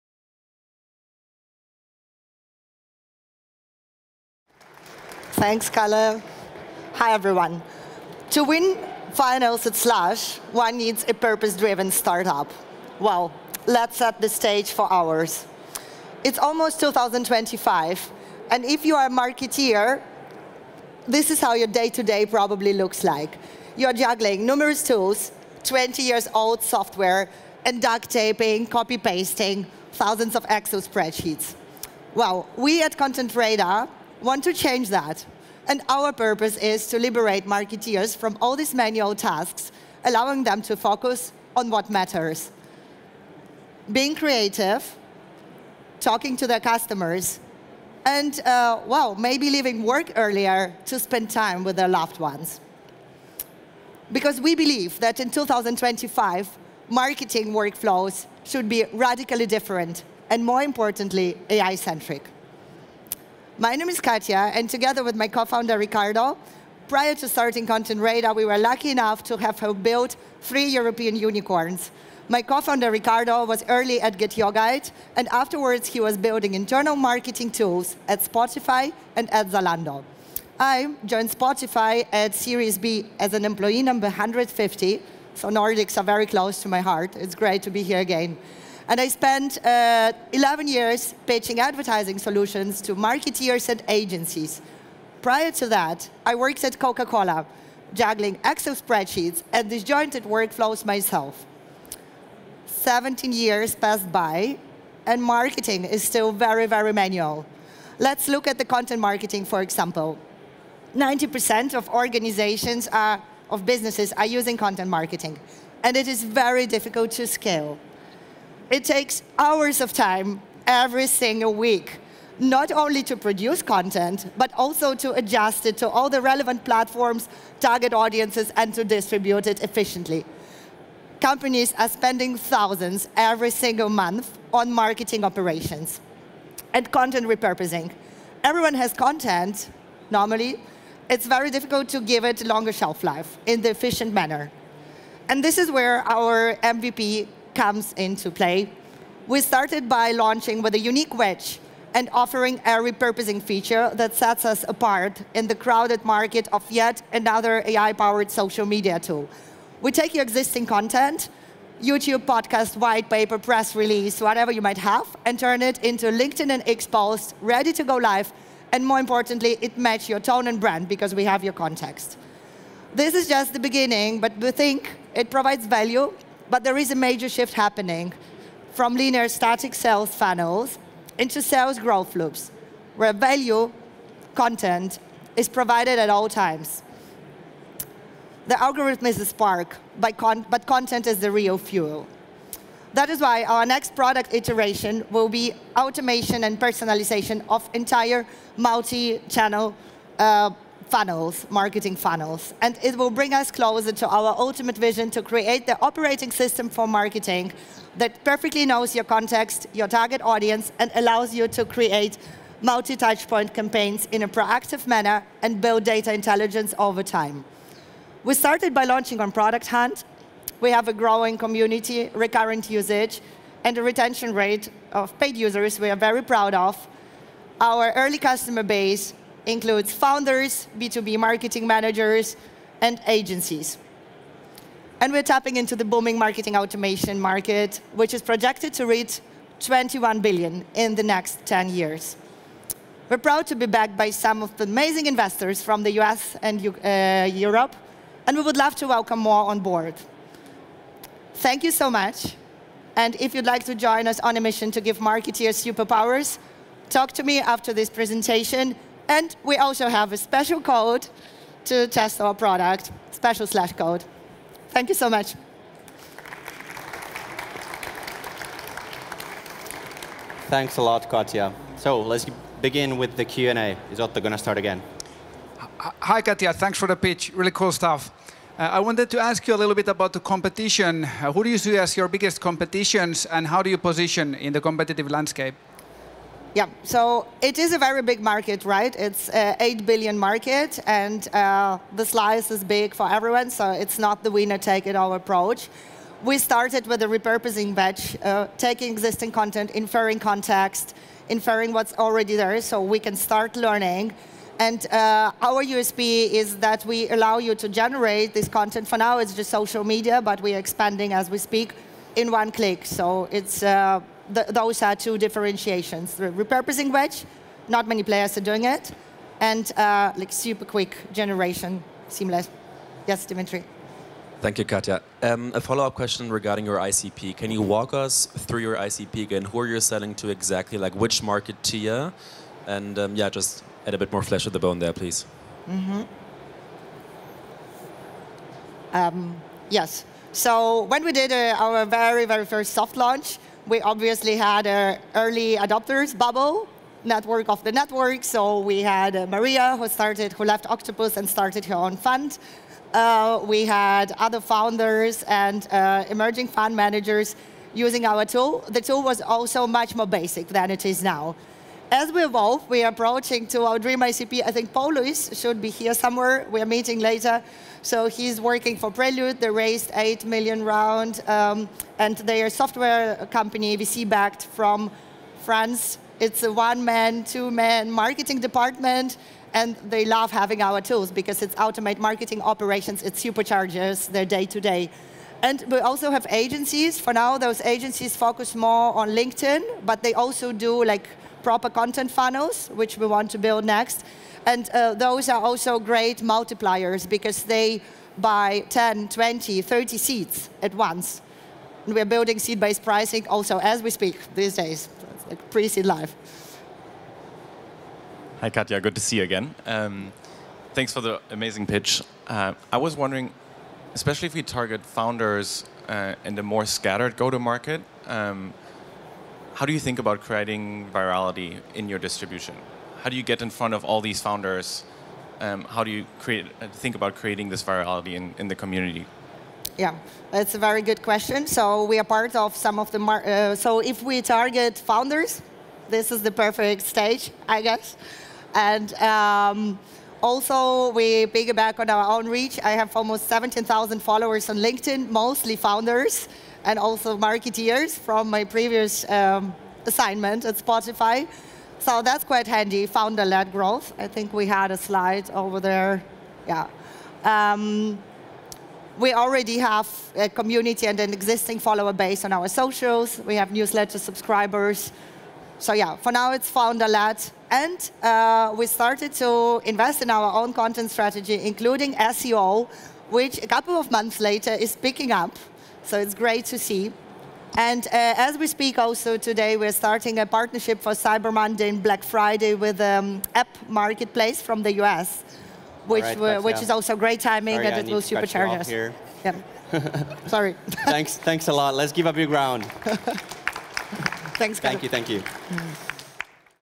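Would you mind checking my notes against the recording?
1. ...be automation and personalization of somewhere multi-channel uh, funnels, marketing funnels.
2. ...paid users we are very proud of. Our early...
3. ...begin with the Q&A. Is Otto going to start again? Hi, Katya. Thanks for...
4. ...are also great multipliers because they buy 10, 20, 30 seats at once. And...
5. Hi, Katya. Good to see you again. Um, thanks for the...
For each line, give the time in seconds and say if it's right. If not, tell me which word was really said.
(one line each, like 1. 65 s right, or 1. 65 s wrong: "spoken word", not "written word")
1. 195 s wrong: "entire", not "somewhere"
2. 225 s right
3. 272 s right
4. 395 s right
5. 408 s right.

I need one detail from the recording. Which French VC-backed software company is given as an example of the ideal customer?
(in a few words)
Prelude.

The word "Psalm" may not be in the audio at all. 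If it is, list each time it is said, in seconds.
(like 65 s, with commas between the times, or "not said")
not said.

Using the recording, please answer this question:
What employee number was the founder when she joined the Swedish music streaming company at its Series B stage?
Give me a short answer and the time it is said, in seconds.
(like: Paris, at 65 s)
150, at 84 s.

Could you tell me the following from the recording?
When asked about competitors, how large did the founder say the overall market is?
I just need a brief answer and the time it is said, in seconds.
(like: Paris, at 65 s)
8 billion, at 289 s.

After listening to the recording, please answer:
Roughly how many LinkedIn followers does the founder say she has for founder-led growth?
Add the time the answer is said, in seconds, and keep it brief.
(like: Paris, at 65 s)
17,000, at 443 s.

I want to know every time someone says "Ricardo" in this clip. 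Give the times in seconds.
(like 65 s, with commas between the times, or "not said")
65 s, 72 s.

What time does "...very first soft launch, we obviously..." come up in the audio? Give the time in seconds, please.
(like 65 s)
342 s.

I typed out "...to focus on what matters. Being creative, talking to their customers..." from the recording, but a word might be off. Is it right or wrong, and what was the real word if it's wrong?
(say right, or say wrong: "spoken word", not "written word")
right.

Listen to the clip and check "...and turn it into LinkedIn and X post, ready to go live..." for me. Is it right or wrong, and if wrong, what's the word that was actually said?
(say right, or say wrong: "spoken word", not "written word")
right.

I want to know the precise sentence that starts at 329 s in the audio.
Who are you selling to exactly?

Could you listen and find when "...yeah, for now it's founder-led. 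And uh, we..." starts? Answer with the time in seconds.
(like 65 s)
465 s.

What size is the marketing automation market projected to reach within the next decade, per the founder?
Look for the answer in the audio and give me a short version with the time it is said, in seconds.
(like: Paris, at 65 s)
21 billion, at 239 s.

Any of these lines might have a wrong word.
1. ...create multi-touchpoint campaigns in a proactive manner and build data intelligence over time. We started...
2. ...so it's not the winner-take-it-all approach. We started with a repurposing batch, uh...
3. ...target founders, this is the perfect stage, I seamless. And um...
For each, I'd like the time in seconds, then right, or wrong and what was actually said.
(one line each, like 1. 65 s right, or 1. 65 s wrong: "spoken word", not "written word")
1. 211 s right
2. 293 s right
3. 434 s wrong: "guess", not "seamless".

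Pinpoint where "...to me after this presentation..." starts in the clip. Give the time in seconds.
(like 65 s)
257 s.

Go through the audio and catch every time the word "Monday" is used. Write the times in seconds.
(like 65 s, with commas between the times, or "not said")
481 s.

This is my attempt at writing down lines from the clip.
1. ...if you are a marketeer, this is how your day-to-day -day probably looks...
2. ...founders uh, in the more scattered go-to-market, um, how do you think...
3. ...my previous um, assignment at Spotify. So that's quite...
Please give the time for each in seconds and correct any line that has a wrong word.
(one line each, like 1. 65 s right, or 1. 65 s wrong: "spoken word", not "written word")
1. 18 s right
2. 414 s right
3. 448 s right.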